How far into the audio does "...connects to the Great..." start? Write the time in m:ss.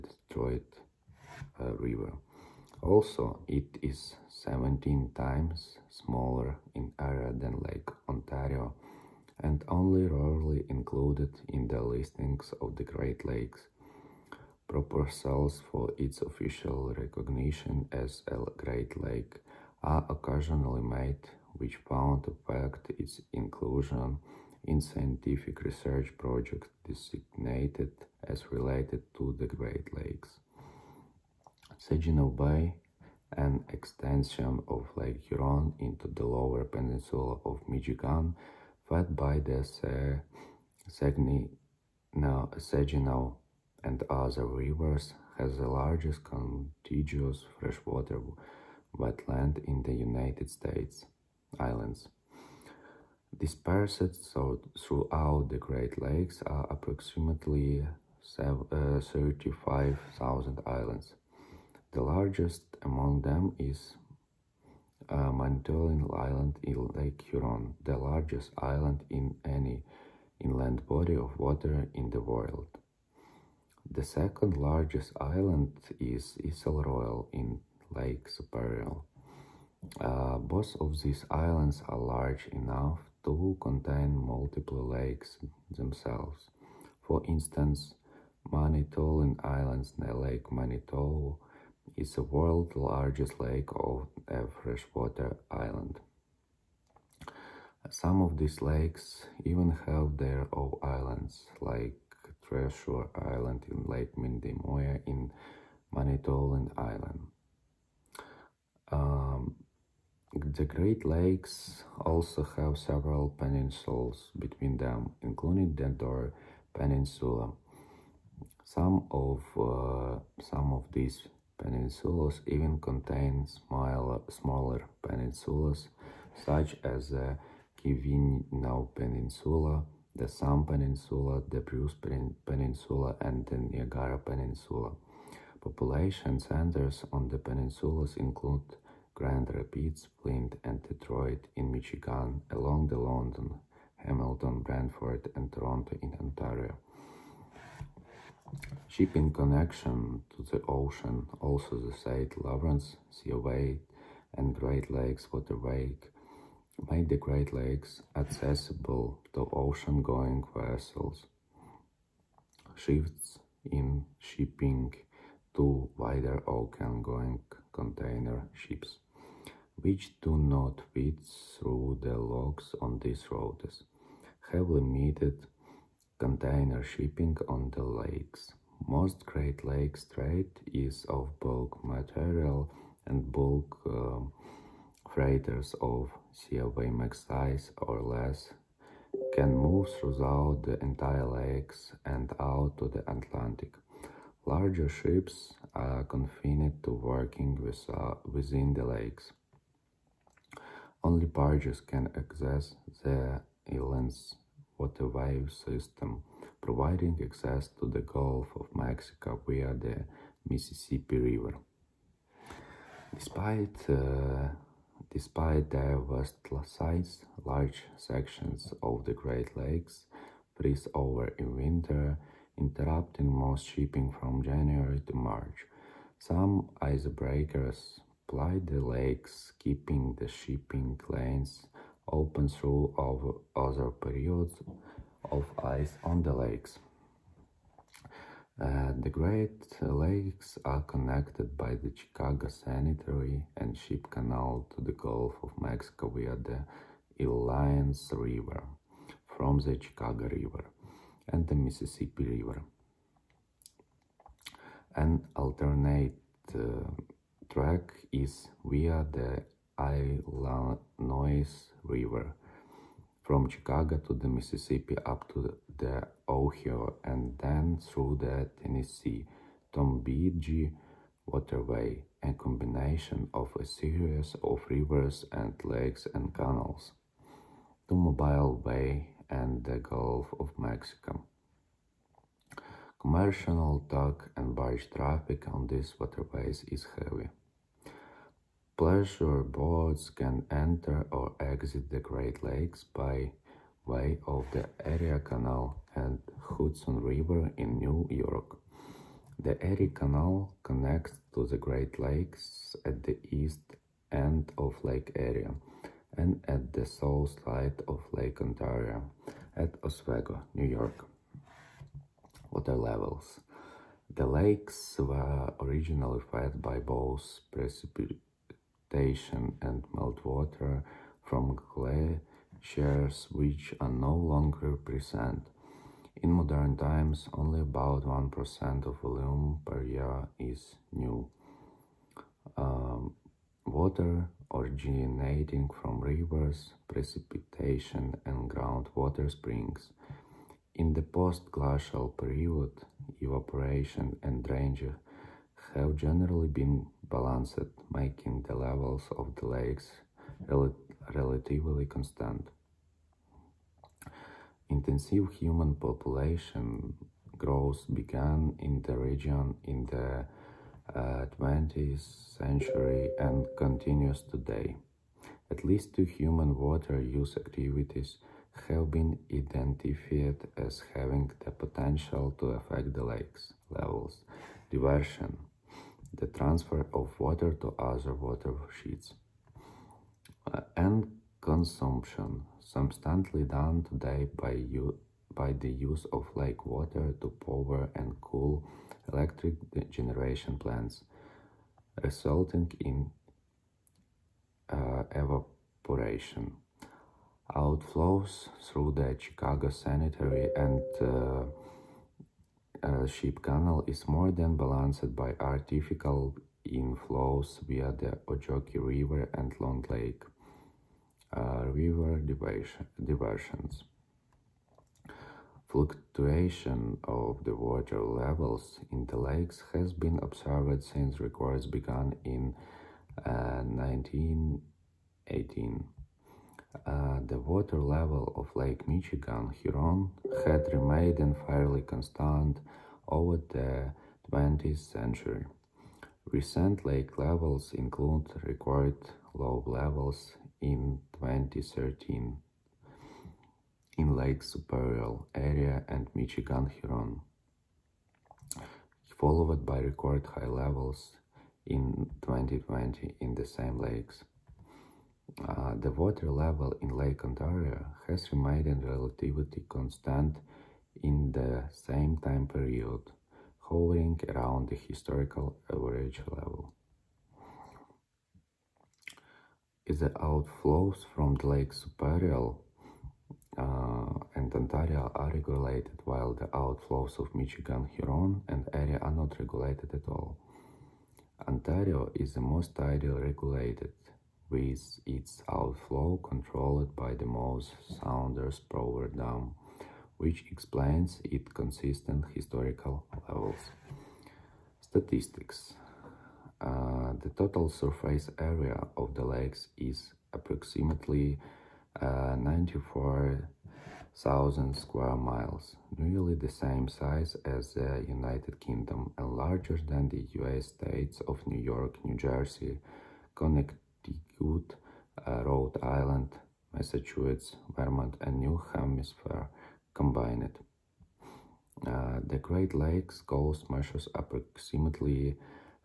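5:00.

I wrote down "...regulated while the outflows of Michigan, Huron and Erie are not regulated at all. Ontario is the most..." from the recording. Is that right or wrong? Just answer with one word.
right.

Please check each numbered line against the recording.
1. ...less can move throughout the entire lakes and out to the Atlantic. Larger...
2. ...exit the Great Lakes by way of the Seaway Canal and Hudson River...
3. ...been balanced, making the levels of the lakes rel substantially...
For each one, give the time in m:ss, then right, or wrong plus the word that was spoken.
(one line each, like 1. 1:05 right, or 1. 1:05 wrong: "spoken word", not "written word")
1. 3:08 right
2. 4:51 wrong: "Erie", not "Seaway"
3. 5:46 wrong: "relatively", not "substantially".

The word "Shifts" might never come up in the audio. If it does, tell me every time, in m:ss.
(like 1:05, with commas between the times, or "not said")
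2:42.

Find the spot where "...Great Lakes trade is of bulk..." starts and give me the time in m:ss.
2:59.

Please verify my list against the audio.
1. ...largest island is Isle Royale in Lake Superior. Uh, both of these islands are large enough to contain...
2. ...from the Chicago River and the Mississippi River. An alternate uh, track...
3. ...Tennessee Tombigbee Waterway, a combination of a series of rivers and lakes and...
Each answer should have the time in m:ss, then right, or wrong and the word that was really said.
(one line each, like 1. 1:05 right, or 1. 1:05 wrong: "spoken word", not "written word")
1. 1:14 right
2. 4:09 right
3. 4:28 right.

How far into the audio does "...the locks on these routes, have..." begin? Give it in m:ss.
2:52.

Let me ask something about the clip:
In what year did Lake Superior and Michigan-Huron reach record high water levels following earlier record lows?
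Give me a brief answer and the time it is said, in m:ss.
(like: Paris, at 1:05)
2020, at 7:32.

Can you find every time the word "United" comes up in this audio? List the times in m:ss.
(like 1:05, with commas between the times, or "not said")
0:49, 8:28.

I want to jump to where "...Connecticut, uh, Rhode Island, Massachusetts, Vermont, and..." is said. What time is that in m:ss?
8:33.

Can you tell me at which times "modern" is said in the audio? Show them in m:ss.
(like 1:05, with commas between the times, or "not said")
5:26.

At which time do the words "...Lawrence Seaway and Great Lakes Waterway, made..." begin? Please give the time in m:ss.
2:32.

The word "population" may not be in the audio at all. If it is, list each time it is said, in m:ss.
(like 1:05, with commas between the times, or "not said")
2:15, 5:55.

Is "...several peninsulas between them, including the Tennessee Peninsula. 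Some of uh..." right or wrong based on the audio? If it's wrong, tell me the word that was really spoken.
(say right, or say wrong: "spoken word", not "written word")
wrong: "Door", not "Tennessee".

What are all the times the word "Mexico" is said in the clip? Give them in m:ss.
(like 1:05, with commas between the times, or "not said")
3:28, 4:05, 4:40.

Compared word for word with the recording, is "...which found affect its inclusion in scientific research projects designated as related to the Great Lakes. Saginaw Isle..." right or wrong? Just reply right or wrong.
wrong.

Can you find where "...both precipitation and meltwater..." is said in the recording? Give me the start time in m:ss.
5:16.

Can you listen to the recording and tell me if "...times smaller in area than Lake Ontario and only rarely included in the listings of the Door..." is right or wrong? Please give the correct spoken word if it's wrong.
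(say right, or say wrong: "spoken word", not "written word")
wrong: "Great", not "Door".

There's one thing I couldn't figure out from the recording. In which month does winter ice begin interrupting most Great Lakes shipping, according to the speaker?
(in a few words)
January.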